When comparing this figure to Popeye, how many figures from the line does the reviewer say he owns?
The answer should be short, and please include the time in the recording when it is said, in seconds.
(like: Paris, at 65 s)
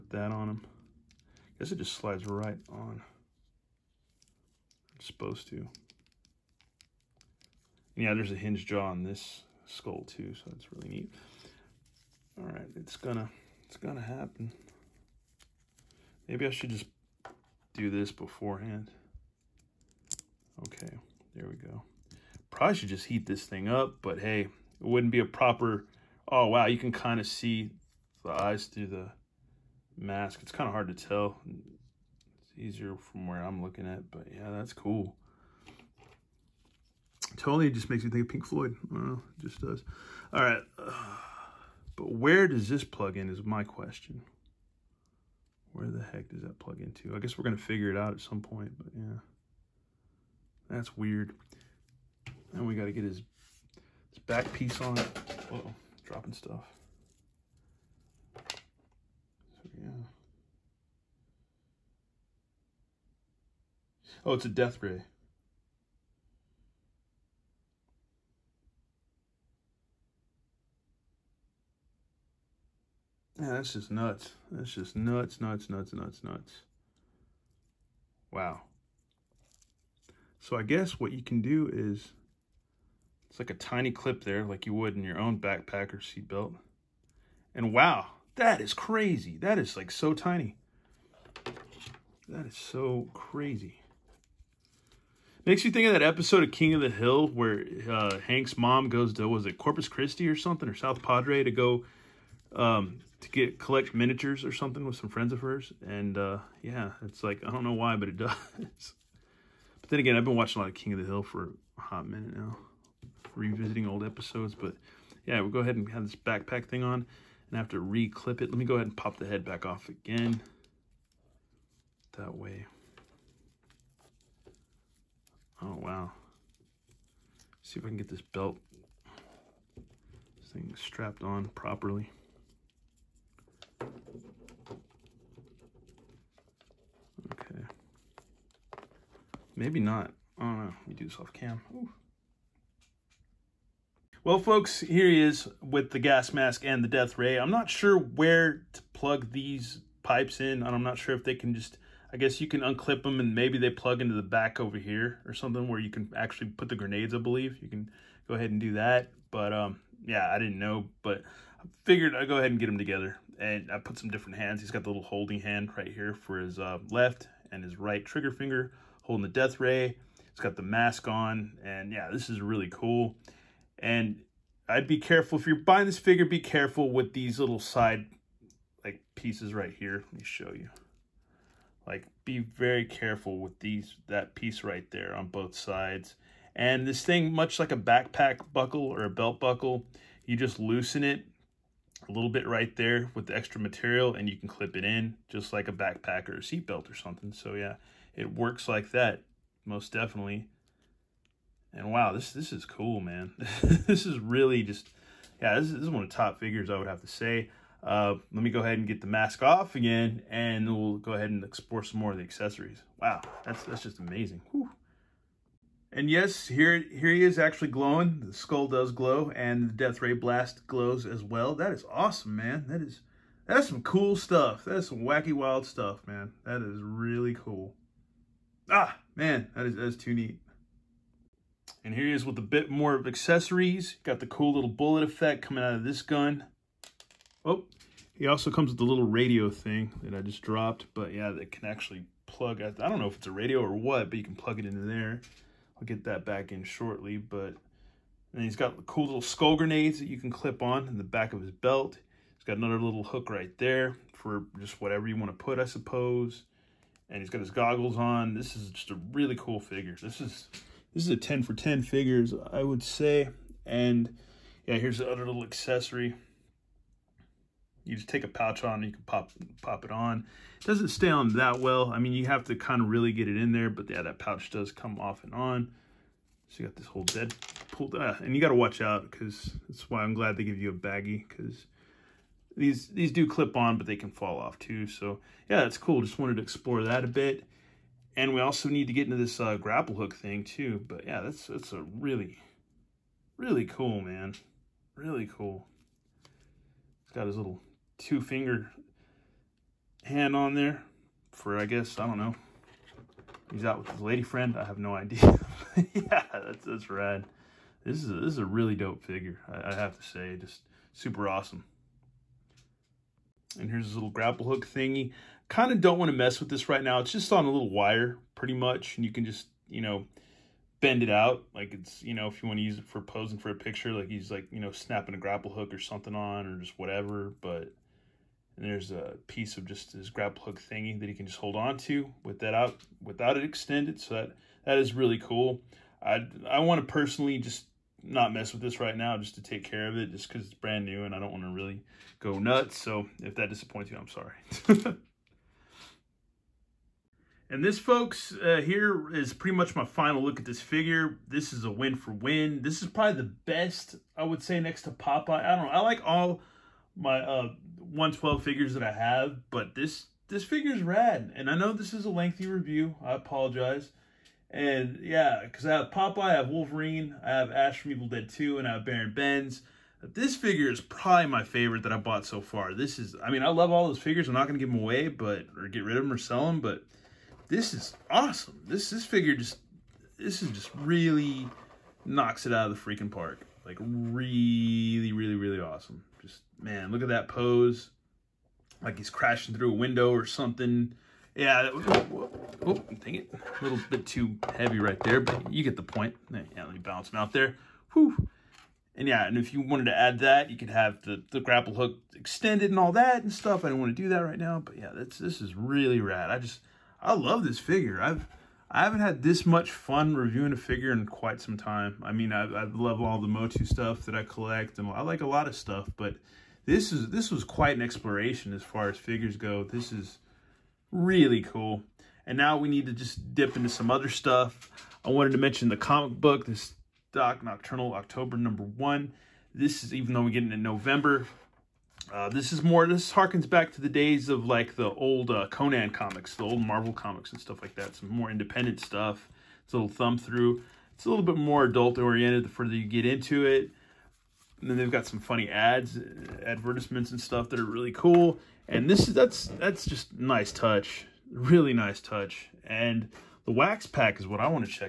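112, at 357 s.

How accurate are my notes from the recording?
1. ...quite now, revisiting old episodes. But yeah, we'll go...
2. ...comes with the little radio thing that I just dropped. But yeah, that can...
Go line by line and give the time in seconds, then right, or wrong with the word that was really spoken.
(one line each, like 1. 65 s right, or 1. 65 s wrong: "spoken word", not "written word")
1. 112 s wrong: "minute", not "quite"
2. 238 s right.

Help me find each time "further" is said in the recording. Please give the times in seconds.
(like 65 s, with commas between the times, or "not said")
442 s.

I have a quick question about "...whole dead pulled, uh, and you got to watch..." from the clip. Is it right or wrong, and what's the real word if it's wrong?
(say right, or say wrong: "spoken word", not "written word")
right.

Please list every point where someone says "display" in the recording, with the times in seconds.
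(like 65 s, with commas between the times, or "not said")
not said.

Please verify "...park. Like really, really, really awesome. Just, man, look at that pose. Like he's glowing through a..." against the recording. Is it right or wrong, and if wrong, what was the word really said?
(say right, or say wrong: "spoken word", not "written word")
wrong: "crashing", not "glowing".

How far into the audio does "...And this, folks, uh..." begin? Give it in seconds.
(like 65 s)
347 s.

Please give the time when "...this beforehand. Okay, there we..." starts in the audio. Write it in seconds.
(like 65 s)
17 s.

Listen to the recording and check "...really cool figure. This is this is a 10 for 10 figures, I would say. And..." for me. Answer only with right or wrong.
right.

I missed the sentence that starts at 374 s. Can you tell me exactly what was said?
I'm not going to give them away, but, or get rid of them or sell them, but this is awesome.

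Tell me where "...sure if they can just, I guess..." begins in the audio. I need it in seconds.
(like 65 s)
150 s.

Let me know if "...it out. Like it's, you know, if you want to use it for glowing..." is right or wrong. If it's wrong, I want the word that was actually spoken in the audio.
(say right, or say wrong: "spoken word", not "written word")
wrong: "posing", not "glowing".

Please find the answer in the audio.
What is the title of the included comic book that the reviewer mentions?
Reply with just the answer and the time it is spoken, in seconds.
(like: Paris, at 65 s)
Doc Nocturnal, at 427 s.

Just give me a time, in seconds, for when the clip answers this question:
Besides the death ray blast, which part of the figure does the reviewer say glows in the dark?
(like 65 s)
218 s.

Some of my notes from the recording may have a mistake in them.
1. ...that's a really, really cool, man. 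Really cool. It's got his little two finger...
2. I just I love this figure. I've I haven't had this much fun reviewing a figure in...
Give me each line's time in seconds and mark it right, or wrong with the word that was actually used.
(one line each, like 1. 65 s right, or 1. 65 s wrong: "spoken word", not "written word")
1. 291 s right
2. 406 s right.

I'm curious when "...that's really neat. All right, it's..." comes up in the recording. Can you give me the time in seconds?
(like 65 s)
10 s.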